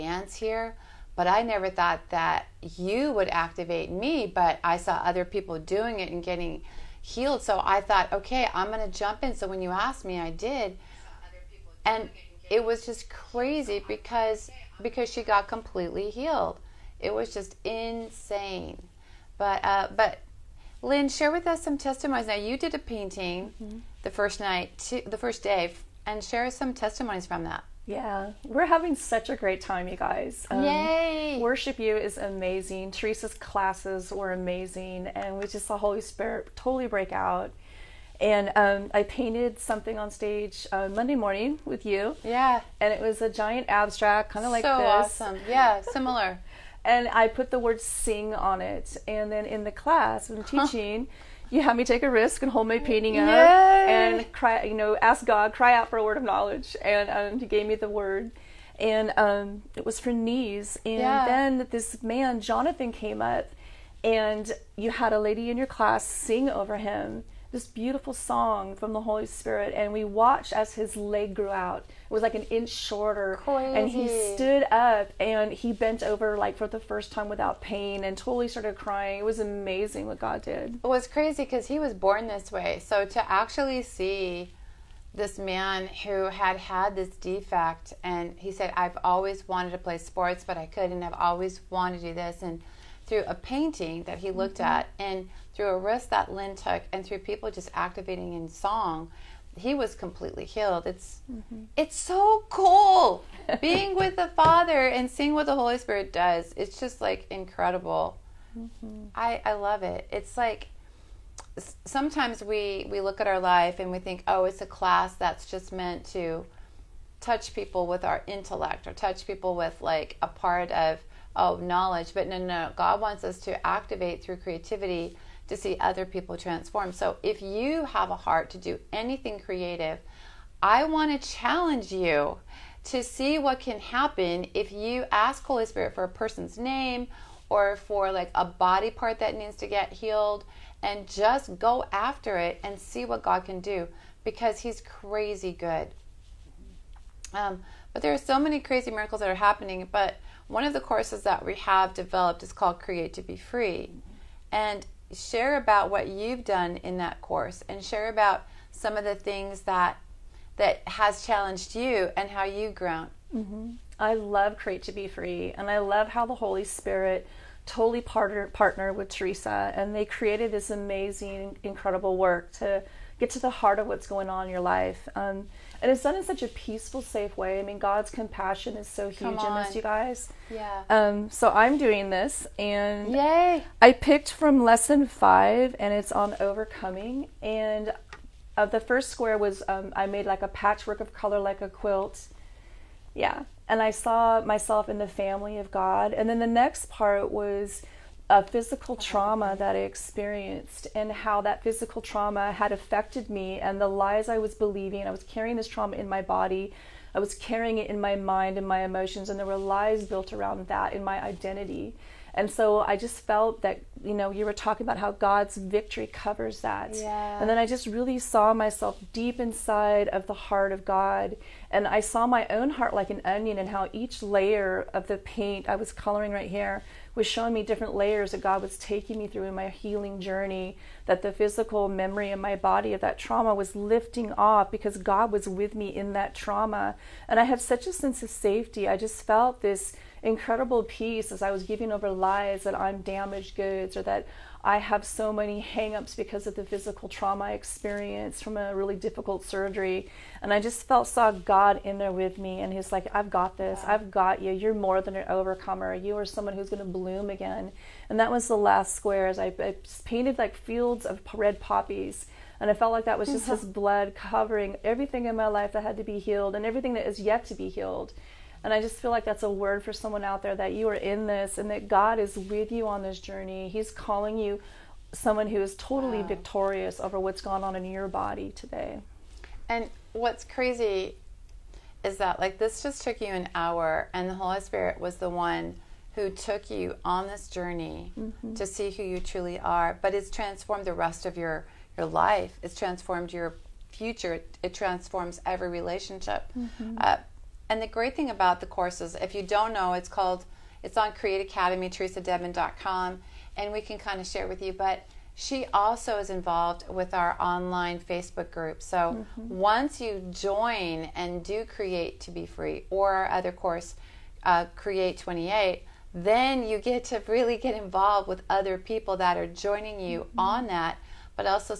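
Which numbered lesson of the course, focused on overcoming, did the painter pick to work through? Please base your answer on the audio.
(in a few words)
5.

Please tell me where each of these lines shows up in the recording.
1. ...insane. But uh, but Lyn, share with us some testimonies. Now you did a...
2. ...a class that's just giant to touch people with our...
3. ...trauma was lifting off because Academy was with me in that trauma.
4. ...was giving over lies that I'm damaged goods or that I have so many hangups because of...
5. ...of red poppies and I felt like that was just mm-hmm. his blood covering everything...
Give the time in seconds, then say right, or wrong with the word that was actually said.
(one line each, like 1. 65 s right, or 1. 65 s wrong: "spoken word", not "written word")
1. 17 s right
2. 114 s wrong: "meant", not "giant"
3. 233 s wrong: "God", not "Academy"
4. 241 s right
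5. 261 s right.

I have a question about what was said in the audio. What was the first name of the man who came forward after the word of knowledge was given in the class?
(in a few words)
Jonathan.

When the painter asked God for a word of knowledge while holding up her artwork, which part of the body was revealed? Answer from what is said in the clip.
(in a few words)
Knees.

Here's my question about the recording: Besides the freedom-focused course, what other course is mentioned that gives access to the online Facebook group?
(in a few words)
Create 28.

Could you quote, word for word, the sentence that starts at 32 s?
Theresa's classes were amazing, and we just saw Holy Spirit totally break out.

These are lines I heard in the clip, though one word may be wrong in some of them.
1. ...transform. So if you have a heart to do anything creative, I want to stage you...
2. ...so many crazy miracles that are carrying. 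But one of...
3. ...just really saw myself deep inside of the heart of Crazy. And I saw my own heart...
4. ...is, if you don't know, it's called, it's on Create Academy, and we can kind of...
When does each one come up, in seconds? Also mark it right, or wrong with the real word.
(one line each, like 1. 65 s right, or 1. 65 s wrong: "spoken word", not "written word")
1. 126 s wrong: "challenge", not "stage"
2. 148 s wrong: "happening", not "carrying"
3. 217 s wrong: "God", not "Crazy"
4. 299 s right.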